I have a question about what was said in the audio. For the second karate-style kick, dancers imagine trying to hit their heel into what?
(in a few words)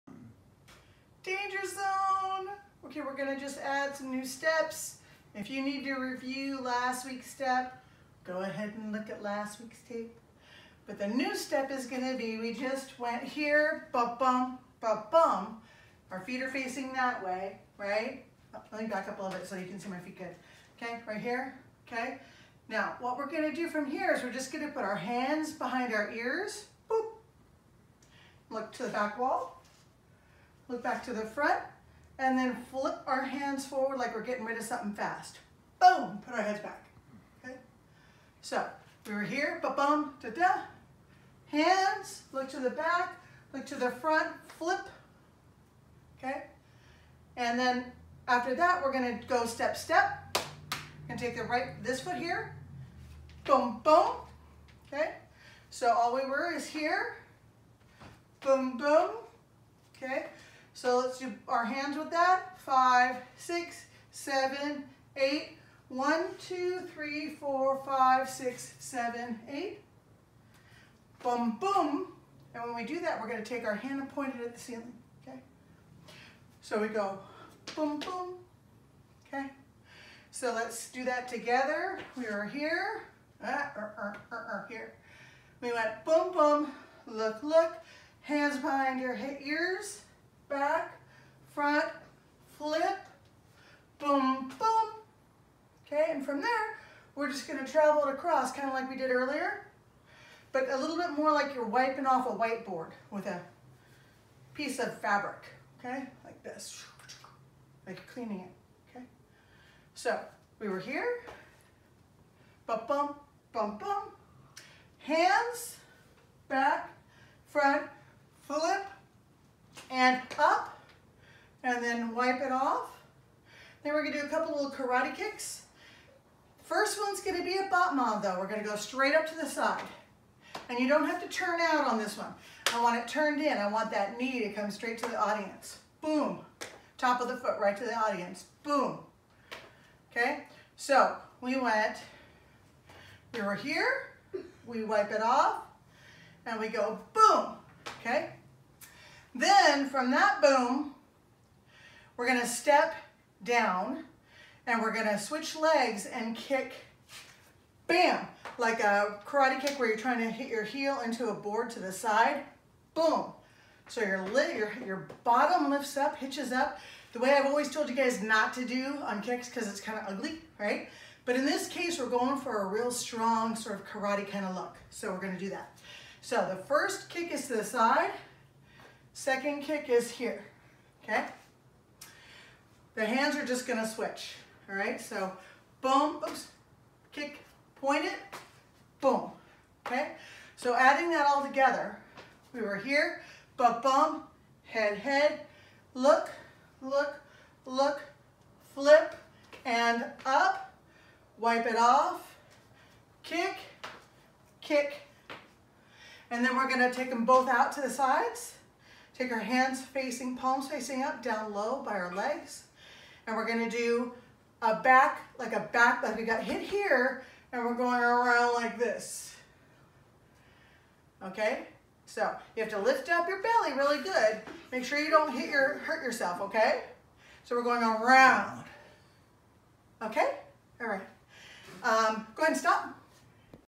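a board.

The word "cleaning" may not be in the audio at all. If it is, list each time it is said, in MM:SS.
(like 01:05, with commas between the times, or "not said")
01:48.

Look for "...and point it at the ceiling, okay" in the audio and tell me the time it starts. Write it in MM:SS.
01:13.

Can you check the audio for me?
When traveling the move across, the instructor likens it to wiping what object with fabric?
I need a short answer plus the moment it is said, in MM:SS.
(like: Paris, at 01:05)
whiteboard, at 01:42.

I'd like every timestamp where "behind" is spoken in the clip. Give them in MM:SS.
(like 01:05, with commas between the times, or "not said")
00:25, 01:28.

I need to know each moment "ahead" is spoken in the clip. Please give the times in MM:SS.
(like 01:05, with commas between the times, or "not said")
00:08, 03:52.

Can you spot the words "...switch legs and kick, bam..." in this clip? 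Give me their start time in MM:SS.
02:35.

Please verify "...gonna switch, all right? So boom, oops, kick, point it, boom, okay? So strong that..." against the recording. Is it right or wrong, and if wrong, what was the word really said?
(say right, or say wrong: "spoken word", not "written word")
wrong: "adding", not "strong".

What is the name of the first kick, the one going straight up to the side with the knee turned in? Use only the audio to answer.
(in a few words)
battement.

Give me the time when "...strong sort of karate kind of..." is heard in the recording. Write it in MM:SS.
02:52.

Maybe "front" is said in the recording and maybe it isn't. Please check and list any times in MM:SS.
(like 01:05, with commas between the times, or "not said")
00:31, 00:43, 01:31, 01:57.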